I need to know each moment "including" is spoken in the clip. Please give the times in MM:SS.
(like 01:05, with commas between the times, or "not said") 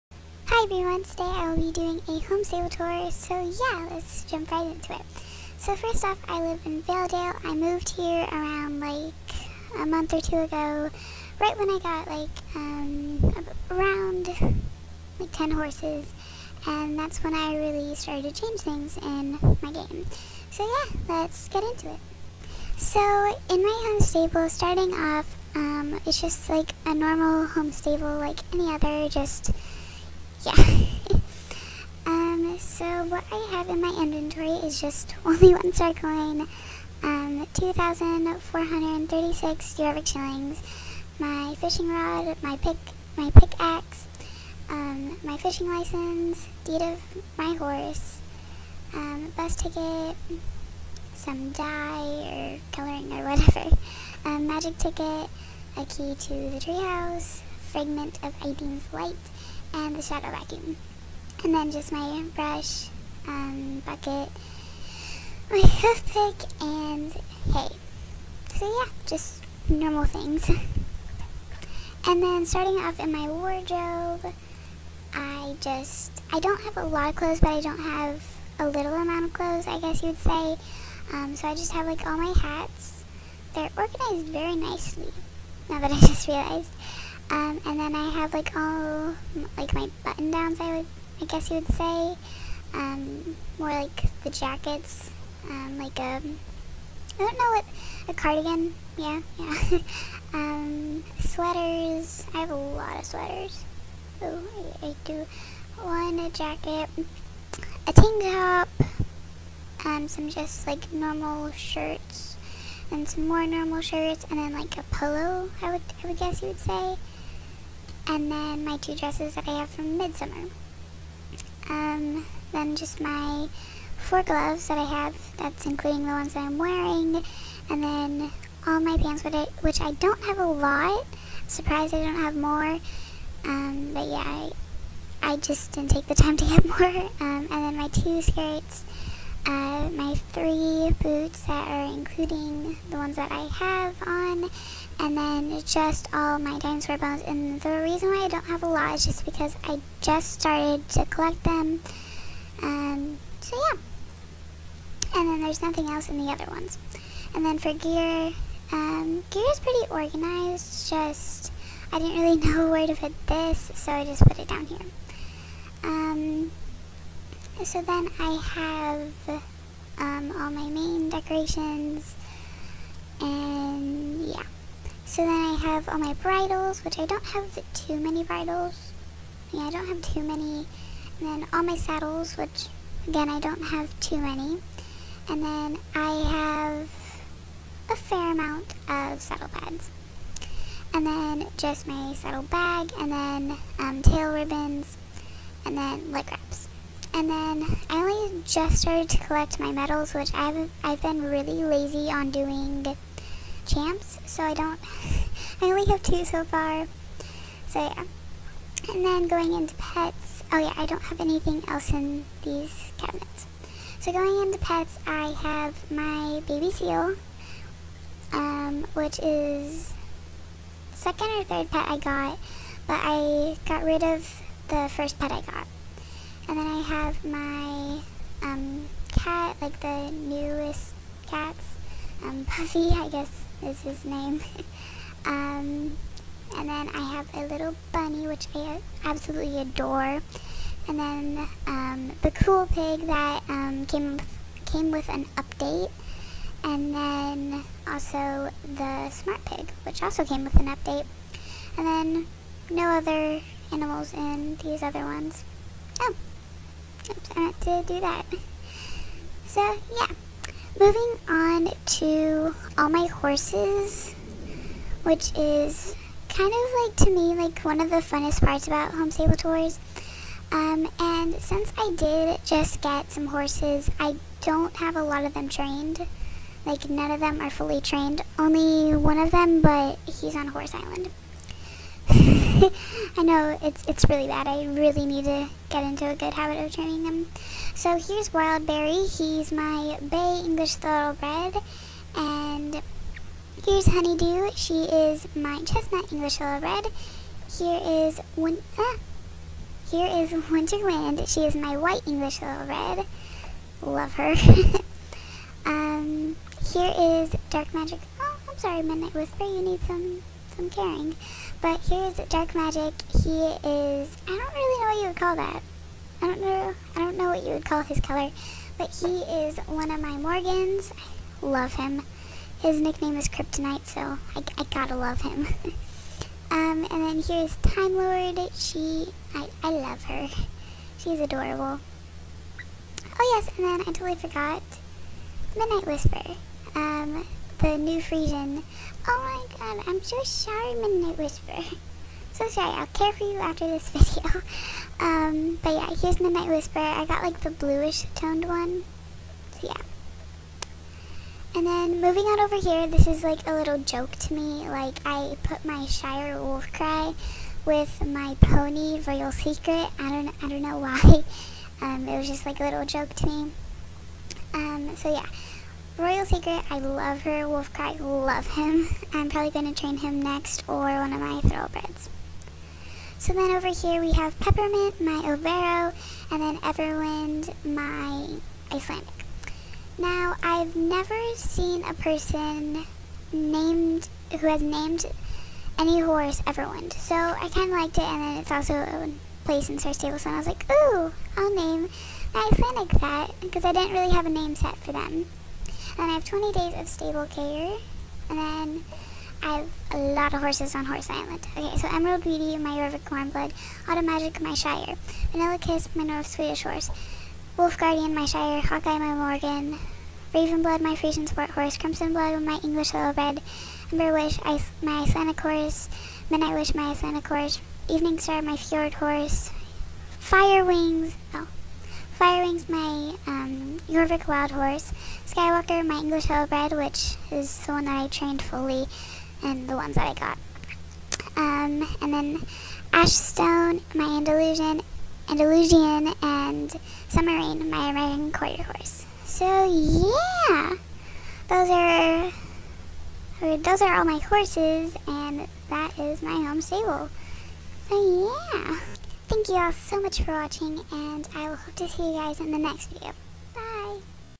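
02:05, 02:21.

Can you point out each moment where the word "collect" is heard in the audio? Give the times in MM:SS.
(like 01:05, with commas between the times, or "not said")
02:31, 03:19.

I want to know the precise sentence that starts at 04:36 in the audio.
Like, none of them are fully trained.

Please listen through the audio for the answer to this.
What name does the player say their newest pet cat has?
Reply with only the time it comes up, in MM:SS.
03:52.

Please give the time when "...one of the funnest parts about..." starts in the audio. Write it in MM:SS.
04:27.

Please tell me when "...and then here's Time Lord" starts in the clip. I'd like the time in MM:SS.
05:26.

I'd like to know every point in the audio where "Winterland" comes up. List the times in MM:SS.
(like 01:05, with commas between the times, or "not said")
05:00.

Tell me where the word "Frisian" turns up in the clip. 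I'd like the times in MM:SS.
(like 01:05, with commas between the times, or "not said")
05:38, 06:50.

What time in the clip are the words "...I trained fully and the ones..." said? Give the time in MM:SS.
07:07.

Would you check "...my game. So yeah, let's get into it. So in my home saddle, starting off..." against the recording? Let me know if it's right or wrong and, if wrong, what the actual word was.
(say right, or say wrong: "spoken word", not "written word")
wrong: "stable", not "saddle".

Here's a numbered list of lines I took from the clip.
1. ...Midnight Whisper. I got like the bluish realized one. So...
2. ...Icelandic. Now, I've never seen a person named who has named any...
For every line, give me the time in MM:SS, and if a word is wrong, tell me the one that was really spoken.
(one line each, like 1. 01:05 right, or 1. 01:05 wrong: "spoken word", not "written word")
1. 05:46 wrong: "toned", not "realized"
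2. 06:18 right.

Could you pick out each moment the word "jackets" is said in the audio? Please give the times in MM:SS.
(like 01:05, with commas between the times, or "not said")
01:34, 01:46.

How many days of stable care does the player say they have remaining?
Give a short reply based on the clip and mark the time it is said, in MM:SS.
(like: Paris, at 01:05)
20, at 06:36.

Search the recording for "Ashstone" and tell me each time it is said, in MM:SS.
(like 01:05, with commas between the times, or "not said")
07:12.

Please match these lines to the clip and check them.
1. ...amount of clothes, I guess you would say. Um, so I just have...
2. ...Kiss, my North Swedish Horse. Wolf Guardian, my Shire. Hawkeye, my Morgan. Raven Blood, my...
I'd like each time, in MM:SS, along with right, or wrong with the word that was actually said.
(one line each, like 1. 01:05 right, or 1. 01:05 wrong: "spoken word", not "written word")
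1. 01:18 right
2. 06:45 right.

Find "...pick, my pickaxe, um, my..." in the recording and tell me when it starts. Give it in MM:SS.
00:42.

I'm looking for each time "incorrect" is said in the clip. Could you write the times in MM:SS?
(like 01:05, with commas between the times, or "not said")
not said.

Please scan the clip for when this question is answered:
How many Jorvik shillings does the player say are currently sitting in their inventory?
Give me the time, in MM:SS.
00:37.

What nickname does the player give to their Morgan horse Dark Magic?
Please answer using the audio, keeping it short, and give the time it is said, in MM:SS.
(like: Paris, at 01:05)
Kryptonite, at 05:23.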